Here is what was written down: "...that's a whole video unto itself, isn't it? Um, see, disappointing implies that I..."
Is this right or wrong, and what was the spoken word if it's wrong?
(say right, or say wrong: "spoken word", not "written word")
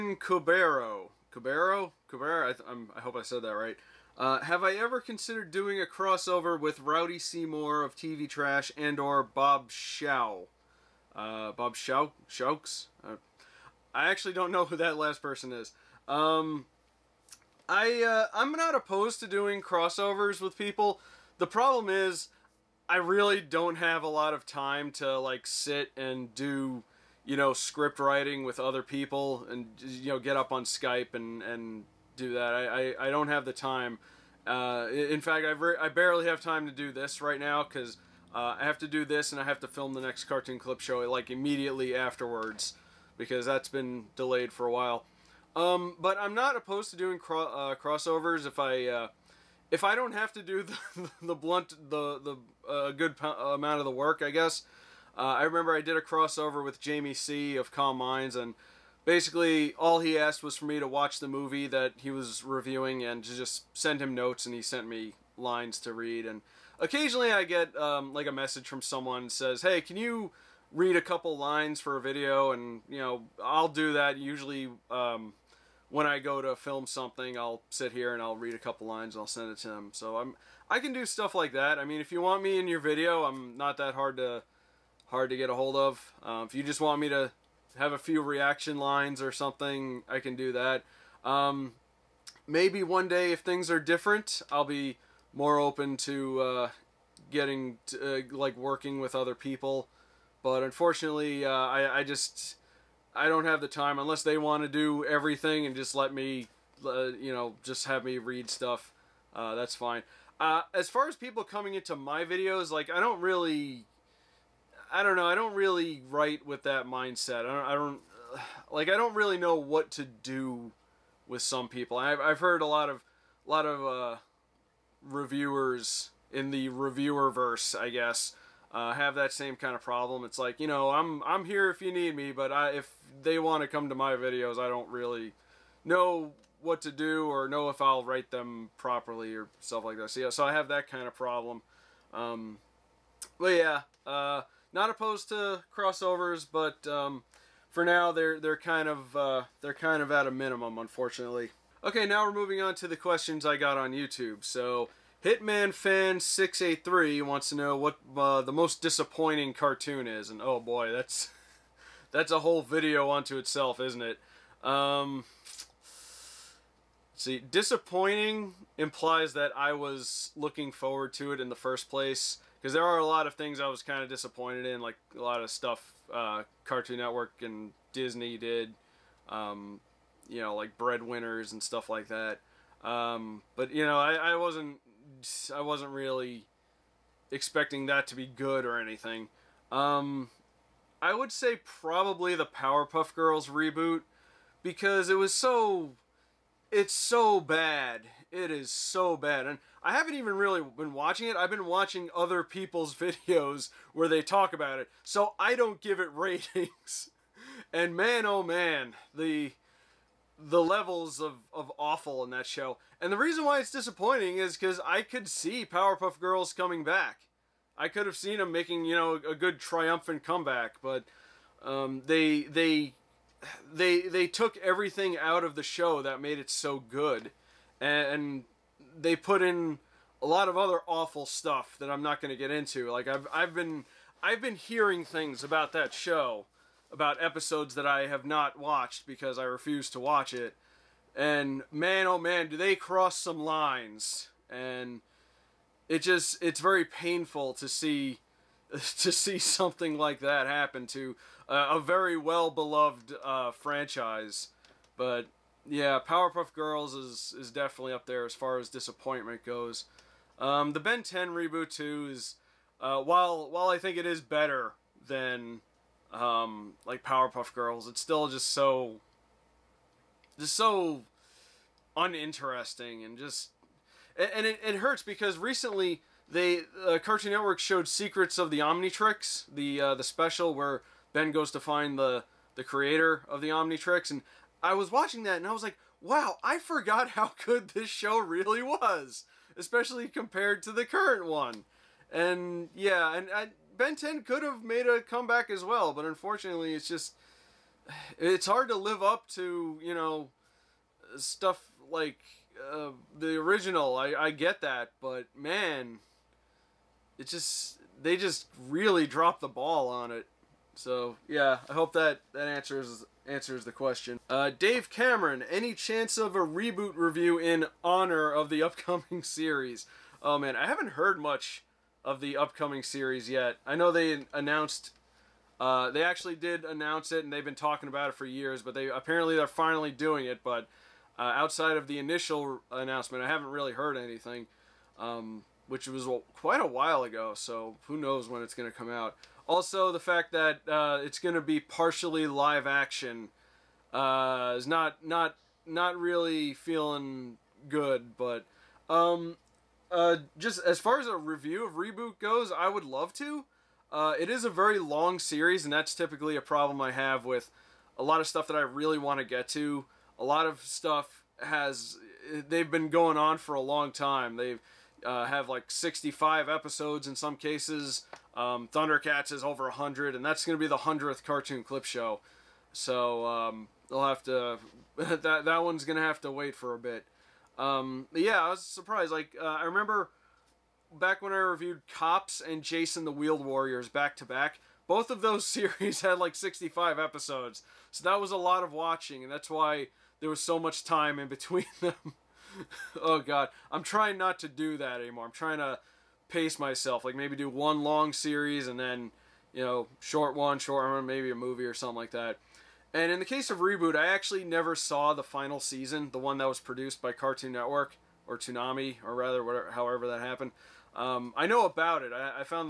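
right.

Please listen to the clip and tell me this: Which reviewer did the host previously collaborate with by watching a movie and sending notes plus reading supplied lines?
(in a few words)
Jamie C.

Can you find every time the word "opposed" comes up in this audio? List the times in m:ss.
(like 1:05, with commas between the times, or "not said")
0:18, 0:46, 2:24.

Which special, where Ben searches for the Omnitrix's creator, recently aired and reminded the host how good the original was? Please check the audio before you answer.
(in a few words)
Secrets of the Omnitrix.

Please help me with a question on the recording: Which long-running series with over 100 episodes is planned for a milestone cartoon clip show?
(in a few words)
Thundercats.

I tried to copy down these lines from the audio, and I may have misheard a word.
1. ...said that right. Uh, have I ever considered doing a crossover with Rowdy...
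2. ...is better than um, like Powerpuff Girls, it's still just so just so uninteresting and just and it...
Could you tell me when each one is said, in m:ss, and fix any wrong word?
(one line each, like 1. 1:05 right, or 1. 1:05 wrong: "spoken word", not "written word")
1. 0:03 right
2. 4:24 right.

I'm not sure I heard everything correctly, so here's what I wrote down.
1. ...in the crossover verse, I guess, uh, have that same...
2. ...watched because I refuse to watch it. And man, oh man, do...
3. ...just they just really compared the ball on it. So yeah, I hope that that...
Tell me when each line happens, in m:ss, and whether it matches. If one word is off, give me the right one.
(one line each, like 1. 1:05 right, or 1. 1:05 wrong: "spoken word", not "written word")
1. 2:06 wrong: "reviewer", not "crossover"
2. 3:58 right
3. 5:07 wrong: "dropped", not "compared".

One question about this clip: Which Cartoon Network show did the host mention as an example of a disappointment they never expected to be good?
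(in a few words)
Breadwinners.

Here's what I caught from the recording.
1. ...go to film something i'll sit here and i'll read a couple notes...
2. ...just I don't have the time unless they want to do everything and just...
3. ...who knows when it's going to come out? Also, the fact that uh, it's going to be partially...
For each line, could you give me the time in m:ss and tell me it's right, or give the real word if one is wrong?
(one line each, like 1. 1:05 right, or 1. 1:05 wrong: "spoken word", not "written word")
1. 1:16 wrong: "lines", not "notes"
2. 1:42 right
3. 5:37 right.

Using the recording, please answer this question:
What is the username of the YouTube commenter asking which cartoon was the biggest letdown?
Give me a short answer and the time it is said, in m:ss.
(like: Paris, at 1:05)
Hitman fan 683, at 2:35.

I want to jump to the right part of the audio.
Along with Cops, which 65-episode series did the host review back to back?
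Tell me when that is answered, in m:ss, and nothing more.
6:22.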